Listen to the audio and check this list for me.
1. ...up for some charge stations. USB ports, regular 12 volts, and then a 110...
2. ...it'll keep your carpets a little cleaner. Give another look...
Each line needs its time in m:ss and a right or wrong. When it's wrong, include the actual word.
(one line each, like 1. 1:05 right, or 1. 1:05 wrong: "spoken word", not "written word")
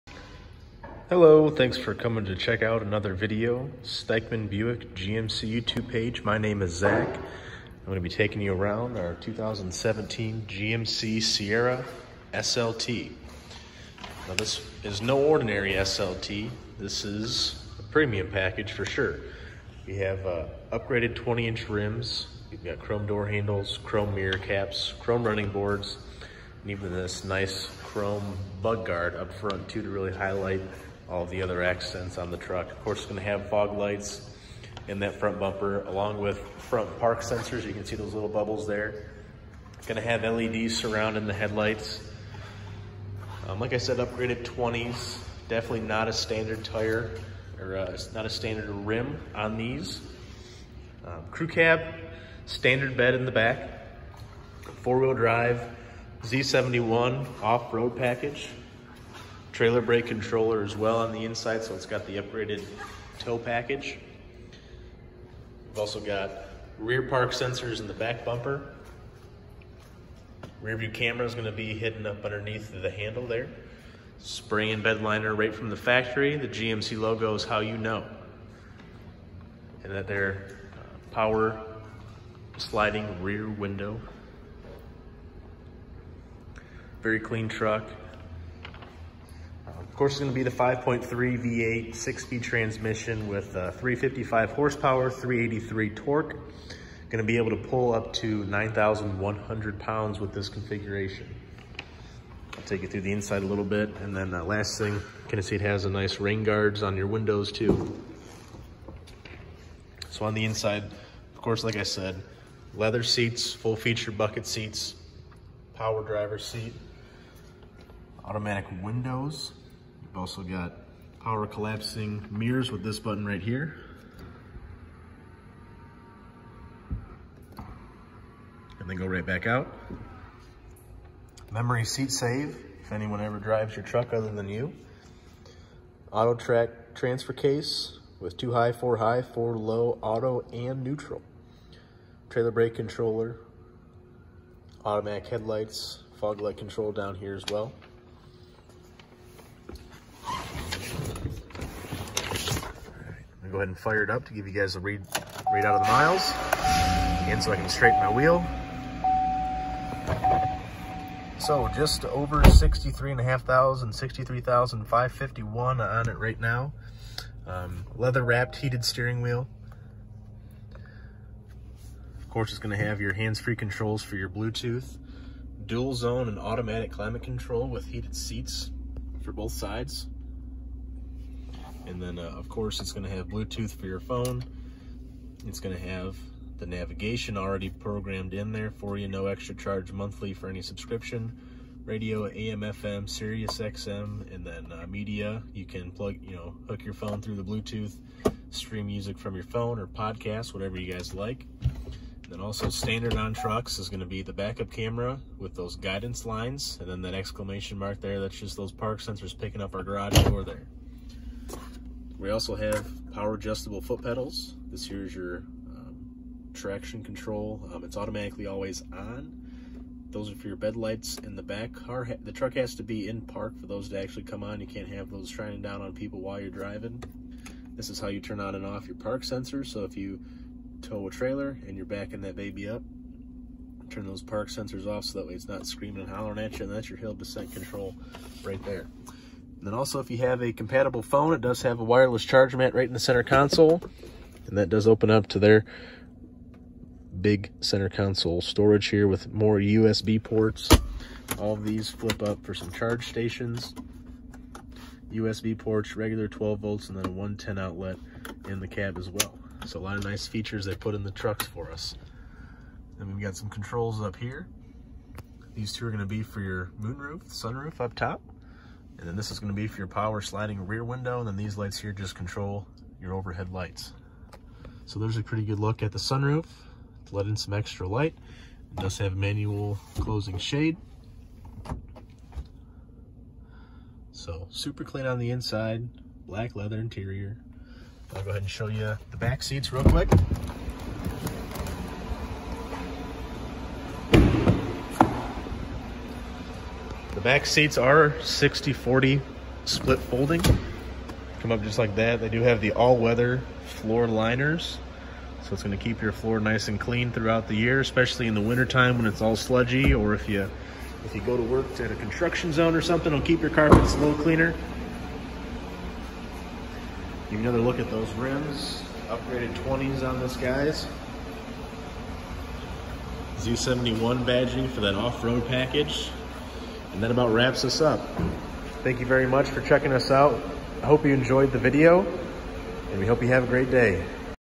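1. 4:12 right
2. 5:13 right.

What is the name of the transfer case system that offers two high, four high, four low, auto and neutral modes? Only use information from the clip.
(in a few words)
Autotrac.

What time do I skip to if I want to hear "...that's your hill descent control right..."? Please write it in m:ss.
3:56.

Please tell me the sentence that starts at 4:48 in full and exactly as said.
I'll go ahead and show you the back seats real quick.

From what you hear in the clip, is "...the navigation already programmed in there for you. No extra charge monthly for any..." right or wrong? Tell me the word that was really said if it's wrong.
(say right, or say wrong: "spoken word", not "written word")
right.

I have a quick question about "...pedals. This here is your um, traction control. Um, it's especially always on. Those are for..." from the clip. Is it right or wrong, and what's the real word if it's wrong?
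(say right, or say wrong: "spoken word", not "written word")
wrong: "automatically", not "especially".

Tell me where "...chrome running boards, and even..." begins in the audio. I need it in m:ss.
0:25.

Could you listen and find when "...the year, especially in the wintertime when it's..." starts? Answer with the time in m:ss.
5:07.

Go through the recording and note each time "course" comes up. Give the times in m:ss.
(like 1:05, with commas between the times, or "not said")
0:32, 1:30, 1:51, 2:52, 3:02.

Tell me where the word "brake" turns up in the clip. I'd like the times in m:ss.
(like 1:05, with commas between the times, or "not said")
0:59, 2:22.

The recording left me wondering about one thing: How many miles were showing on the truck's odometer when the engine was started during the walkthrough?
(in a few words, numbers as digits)
63,551.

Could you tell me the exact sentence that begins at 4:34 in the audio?
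So there's a pretty good look at the sunroof to let in some extra light.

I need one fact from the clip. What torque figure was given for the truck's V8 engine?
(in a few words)
383.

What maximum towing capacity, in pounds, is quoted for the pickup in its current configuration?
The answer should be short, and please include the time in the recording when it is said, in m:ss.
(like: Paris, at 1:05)
9,100, at 1:38.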